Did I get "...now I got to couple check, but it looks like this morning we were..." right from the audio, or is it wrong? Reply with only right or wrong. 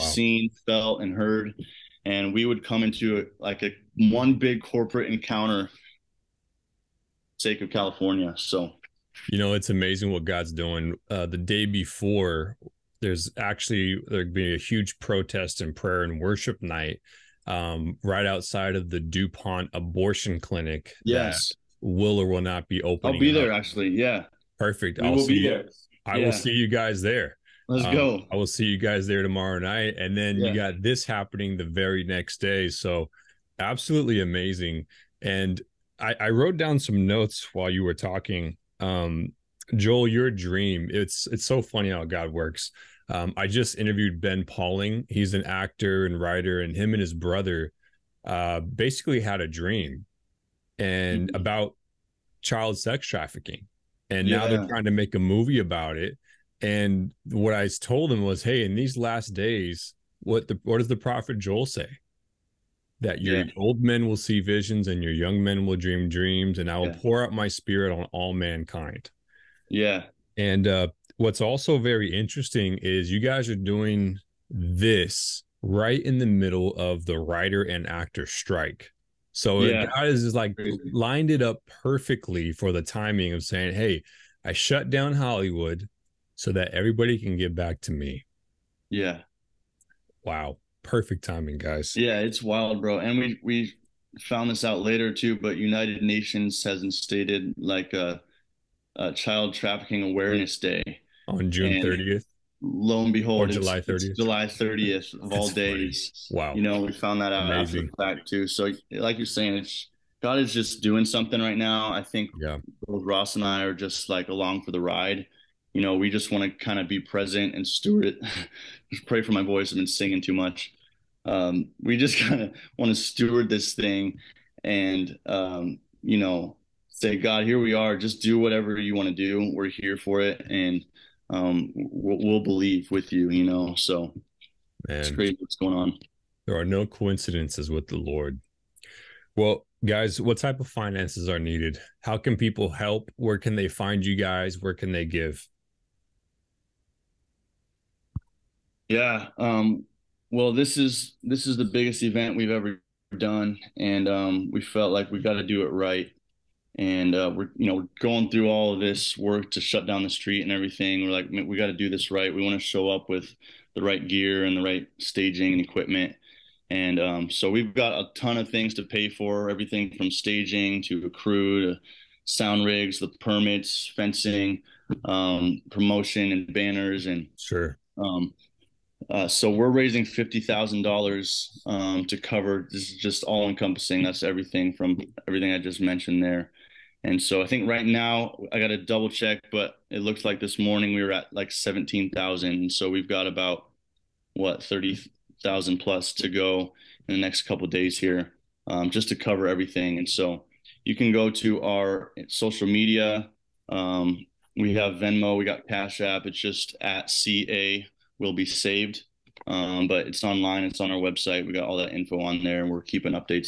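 wrong.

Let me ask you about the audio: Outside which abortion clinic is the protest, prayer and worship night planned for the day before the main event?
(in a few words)
DuPont.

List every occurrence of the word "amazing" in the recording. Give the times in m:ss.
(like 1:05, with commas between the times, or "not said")
0:09, 0:34, 1:47.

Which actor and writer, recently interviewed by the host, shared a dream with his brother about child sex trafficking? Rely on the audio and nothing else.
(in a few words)
Ben Pauling.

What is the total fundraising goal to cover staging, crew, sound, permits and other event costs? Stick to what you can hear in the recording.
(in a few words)
$50,000.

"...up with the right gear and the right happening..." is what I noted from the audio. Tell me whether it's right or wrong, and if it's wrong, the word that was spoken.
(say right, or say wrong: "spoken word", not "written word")
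wrong: "staging", not "happening".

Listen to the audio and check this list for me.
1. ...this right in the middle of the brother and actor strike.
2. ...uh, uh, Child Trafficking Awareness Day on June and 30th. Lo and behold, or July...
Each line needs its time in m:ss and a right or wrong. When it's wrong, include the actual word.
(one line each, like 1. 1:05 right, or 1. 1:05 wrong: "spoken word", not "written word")
1. 1:14 wrong: "writer", not "brother"
2. 1:38 right.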